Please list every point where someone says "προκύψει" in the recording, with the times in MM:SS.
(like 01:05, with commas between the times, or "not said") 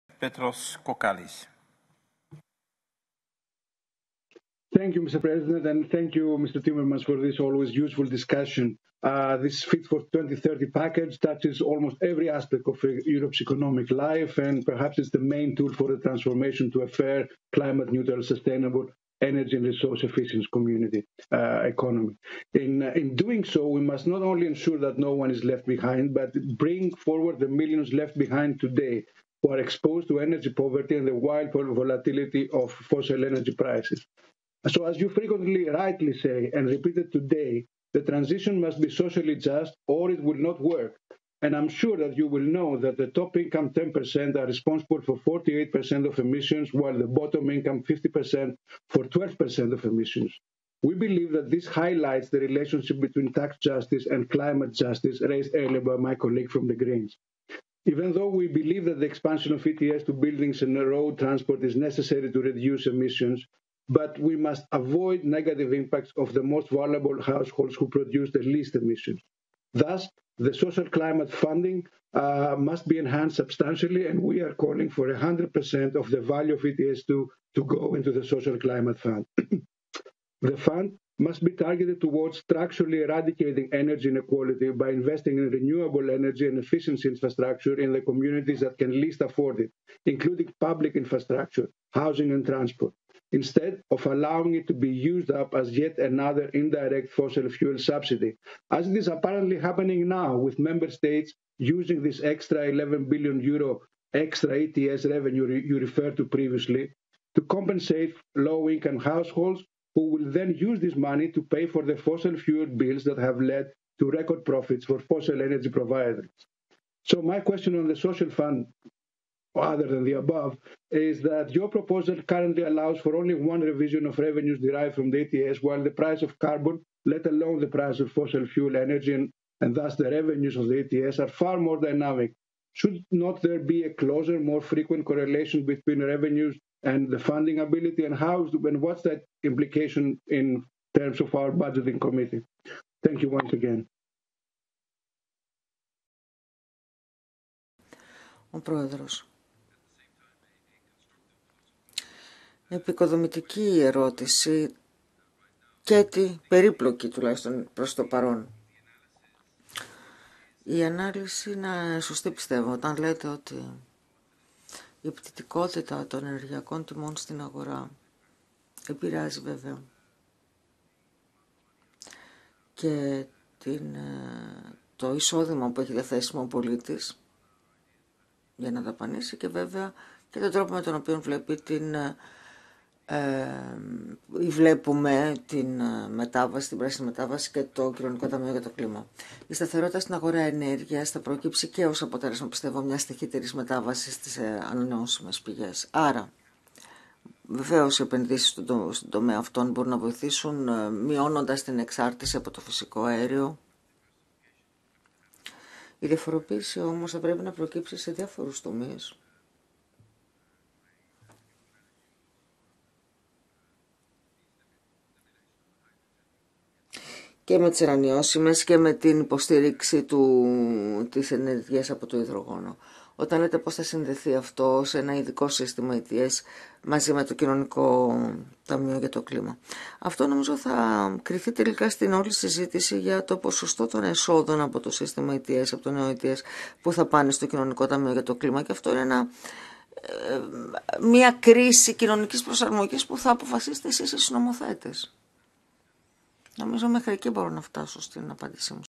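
03:11, 03:27.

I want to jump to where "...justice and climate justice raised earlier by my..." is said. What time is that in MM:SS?
00:53.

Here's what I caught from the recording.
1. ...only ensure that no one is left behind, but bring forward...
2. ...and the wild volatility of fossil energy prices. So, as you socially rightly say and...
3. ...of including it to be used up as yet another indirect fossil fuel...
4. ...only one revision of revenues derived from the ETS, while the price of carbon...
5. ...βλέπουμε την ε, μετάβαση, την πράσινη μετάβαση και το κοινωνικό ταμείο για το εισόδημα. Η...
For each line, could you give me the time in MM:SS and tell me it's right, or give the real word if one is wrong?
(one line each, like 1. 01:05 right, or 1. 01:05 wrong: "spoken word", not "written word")
1. 00:24 right
2. 00:30 wrong: "frequently", not "socially"
3. 01:33 wrong: "allowing", not "including"
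4. 02:03 right
5. 03:04 wrong: "κλίμα", not "εισόδημα".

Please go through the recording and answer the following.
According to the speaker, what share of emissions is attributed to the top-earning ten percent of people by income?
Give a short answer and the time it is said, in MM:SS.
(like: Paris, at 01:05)
48%, at 00:45.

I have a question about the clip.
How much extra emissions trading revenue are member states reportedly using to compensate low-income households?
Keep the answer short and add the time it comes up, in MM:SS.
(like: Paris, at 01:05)
11 billion euro, at 01:42.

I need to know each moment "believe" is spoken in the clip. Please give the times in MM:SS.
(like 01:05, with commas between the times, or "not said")
00:50, 00:58.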